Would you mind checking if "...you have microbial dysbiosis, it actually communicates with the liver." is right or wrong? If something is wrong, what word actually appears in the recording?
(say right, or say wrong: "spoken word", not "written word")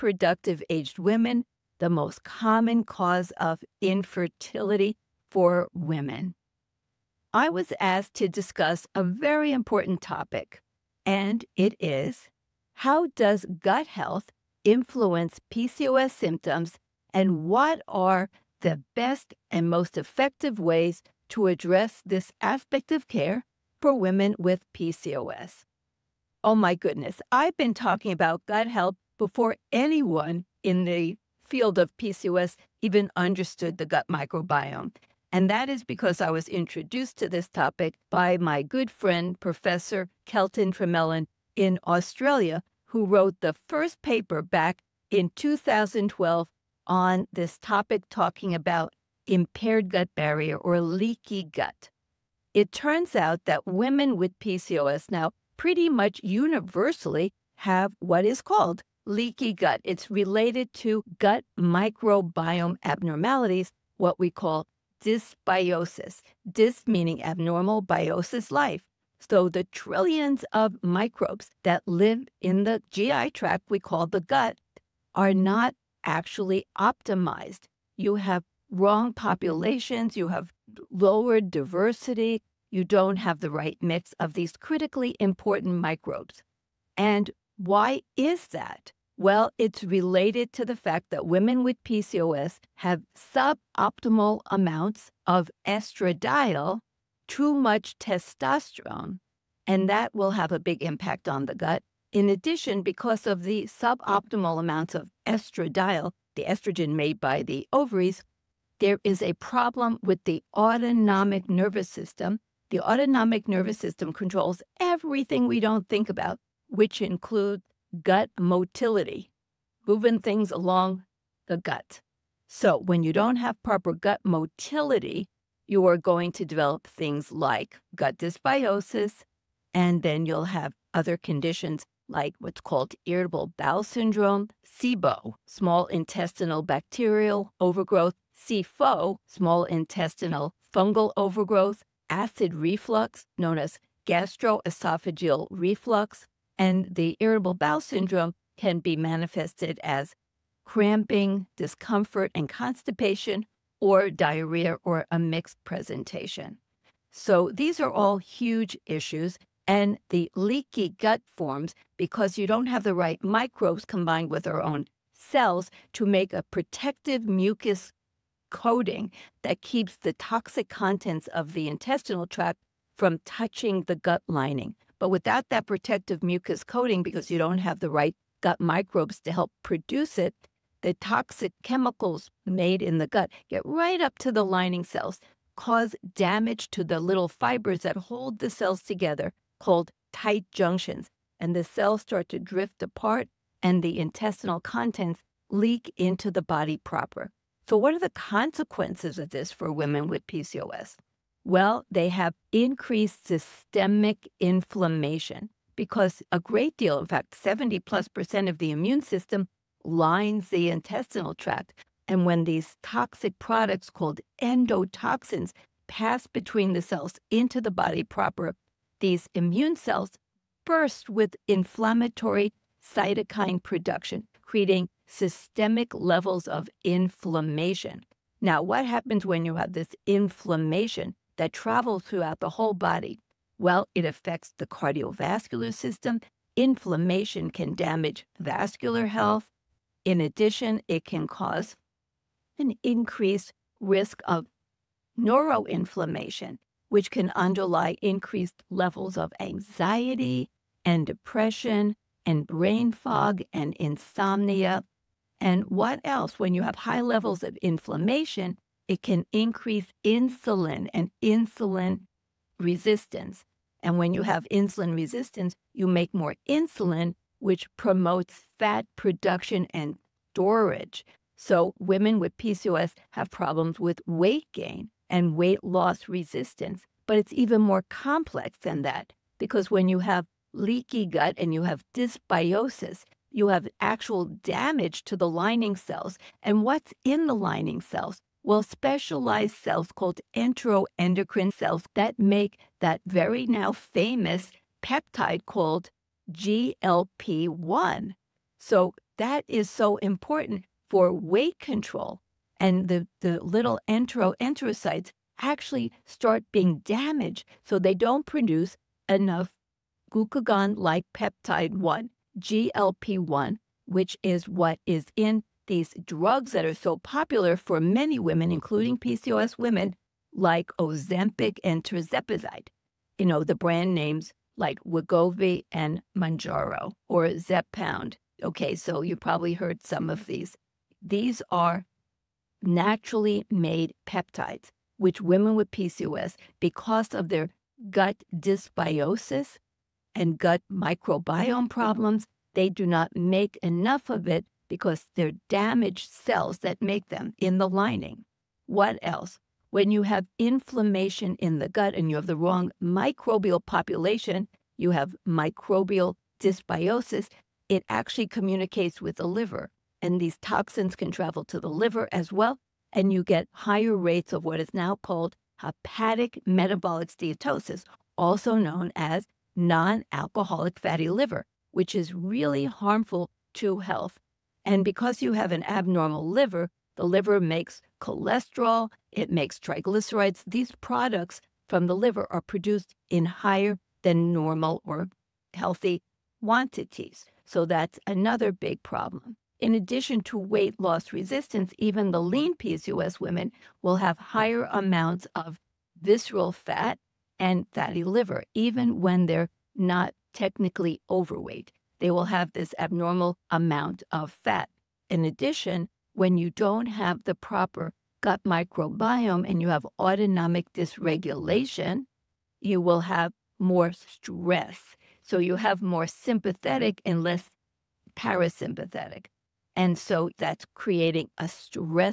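right.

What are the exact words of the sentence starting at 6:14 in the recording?
And because you have an abnormal liver, the liver makes cholesterol, it makes triglycerides.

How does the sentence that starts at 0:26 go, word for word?
Oh my goodness, I've been talking about gut health before anyone in the field of PCOS even understood the gut microbiome.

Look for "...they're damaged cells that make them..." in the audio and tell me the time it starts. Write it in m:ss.
5:45.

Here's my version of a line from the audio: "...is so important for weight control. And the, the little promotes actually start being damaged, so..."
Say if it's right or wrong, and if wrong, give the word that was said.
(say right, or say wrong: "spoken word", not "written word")
wrong: "enteroenterocytes", not "promotes".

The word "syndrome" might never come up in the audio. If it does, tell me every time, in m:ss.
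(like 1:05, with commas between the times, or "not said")
2:13, 2:27.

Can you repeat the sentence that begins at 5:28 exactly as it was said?
Okay, so you probably heard some of these.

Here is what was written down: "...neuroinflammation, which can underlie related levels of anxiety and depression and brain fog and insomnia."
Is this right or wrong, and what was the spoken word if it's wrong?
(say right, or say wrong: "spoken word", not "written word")
wrong: "increased", not "related".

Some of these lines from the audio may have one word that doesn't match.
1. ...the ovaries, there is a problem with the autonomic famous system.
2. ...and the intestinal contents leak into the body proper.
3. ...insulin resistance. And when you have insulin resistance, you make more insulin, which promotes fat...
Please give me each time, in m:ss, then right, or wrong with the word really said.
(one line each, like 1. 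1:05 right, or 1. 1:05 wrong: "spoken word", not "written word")
1. 1:47 wrong: "nervous", not "famous"
2. 3:13 right
3. 4:21 right.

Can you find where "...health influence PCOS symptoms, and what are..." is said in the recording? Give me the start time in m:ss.
0:13.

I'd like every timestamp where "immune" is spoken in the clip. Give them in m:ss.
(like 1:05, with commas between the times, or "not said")
3:28, 3:39.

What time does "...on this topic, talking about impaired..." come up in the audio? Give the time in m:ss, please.
0:46.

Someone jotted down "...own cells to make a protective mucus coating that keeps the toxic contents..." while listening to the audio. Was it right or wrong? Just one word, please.
right.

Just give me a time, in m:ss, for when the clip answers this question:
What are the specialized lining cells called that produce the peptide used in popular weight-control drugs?
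4:50.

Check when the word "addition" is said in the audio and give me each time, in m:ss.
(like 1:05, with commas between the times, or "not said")
1:42, 4:00, 6:29, 6:45.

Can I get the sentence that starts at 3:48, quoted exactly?
Now, what happens when you have this inflammation?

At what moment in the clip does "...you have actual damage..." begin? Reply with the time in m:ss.
4:43.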